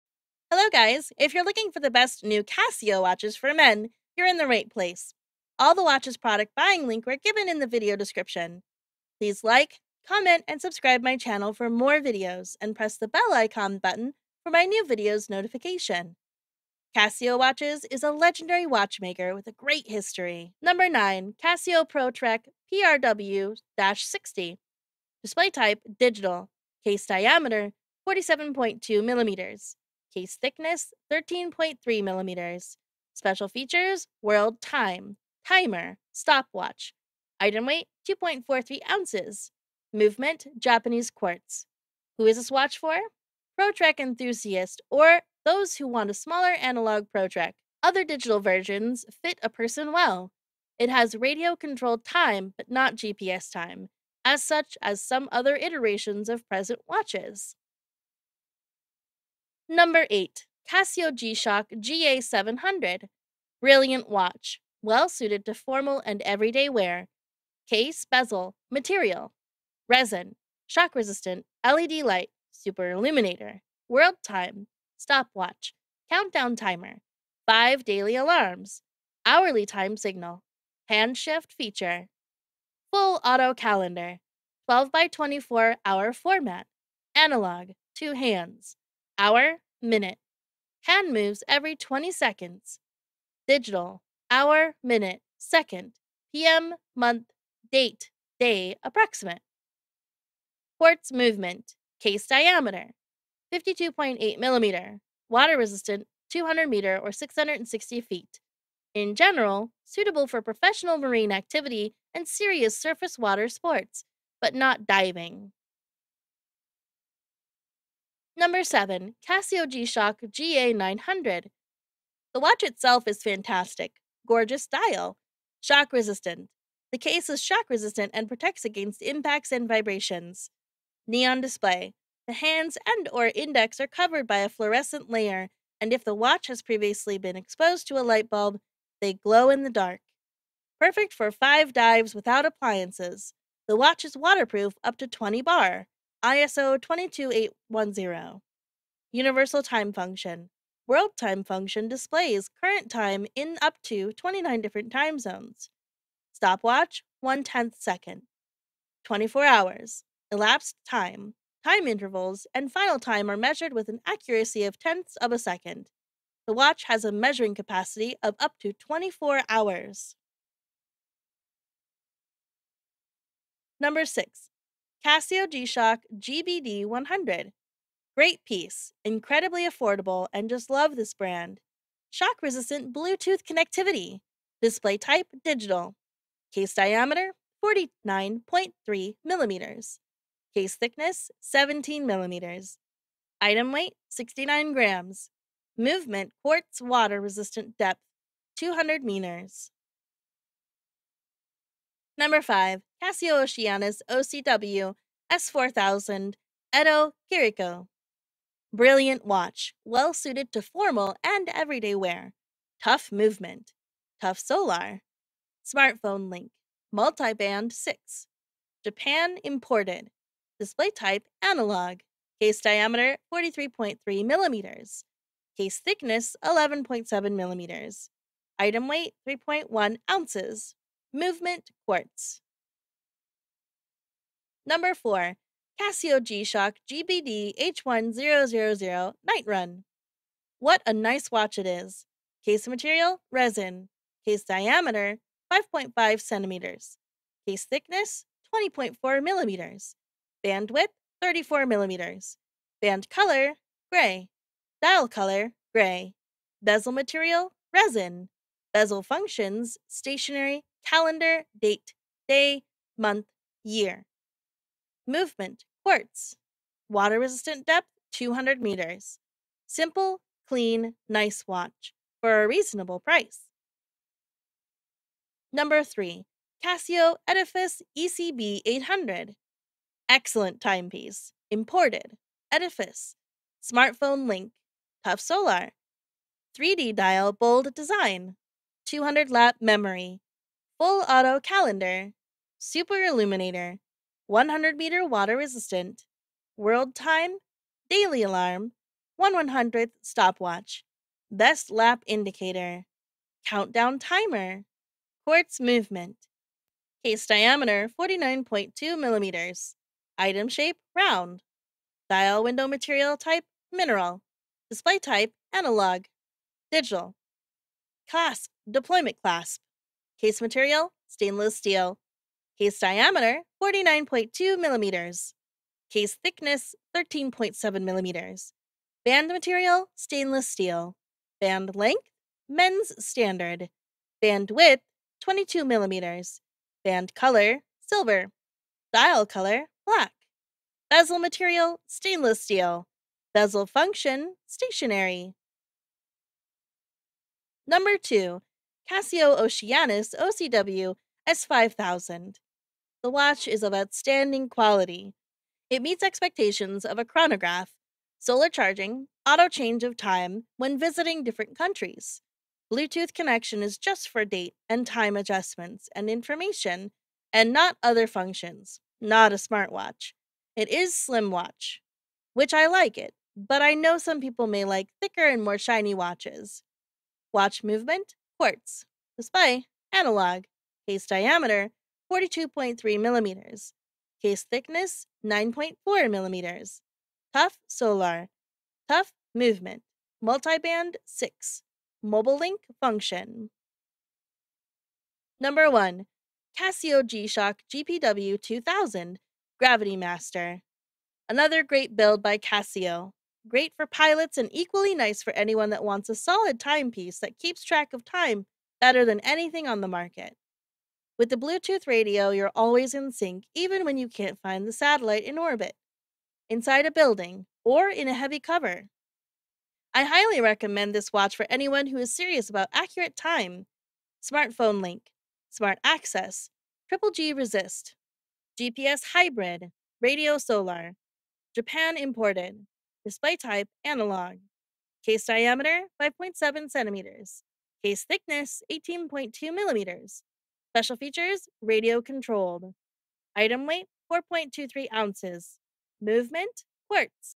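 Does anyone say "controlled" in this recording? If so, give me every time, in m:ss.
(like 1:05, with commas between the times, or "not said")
0:51, 7:22.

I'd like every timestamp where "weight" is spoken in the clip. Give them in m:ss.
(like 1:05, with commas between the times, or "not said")
0:37, 3:13, 3:48, 7:23.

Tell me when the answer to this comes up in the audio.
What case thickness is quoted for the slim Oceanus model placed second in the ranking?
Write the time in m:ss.
6:25.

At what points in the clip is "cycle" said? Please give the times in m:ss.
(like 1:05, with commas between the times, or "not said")
not said.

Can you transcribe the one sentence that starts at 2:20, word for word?
Perfect for 5 dives without appliances.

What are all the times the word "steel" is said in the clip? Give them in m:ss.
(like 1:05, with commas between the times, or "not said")
5:21, 5:30, 5:42.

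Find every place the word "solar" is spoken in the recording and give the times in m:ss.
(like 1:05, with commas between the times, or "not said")
3:34, 4:45, 5:58, 6:27, 7:10.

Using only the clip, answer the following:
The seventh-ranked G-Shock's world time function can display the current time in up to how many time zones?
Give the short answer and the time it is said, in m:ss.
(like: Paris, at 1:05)
29, at 2:34.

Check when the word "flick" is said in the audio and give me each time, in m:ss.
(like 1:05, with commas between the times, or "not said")
not said.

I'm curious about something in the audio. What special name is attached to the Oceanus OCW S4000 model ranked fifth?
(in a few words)
Edo Kiriko.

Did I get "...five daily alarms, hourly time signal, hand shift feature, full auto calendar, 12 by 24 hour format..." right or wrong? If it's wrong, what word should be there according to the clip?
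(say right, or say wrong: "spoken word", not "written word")
right.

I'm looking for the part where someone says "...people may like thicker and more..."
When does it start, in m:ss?
6:14.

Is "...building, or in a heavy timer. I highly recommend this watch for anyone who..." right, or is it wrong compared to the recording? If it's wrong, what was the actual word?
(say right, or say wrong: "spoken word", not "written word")
wrong: "cover", not "timer".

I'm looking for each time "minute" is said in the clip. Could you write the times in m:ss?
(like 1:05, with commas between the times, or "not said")
1:29, 1:34.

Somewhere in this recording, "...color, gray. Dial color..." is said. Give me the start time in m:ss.
4:13.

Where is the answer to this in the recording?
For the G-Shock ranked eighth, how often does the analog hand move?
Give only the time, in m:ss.
1:31.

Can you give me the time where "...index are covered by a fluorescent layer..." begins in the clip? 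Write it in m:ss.
2:13.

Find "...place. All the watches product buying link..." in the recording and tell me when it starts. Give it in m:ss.
0:04.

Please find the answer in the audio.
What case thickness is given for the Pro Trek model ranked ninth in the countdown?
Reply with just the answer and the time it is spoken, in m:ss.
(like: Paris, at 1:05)
13.3 millimeters, at 0:31.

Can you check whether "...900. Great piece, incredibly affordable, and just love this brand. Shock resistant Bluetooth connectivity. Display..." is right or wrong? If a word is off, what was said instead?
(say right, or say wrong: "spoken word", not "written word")
wrong: "100", not "900".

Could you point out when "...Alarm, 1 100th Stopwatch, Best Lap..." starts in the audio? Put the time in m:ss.
4:58.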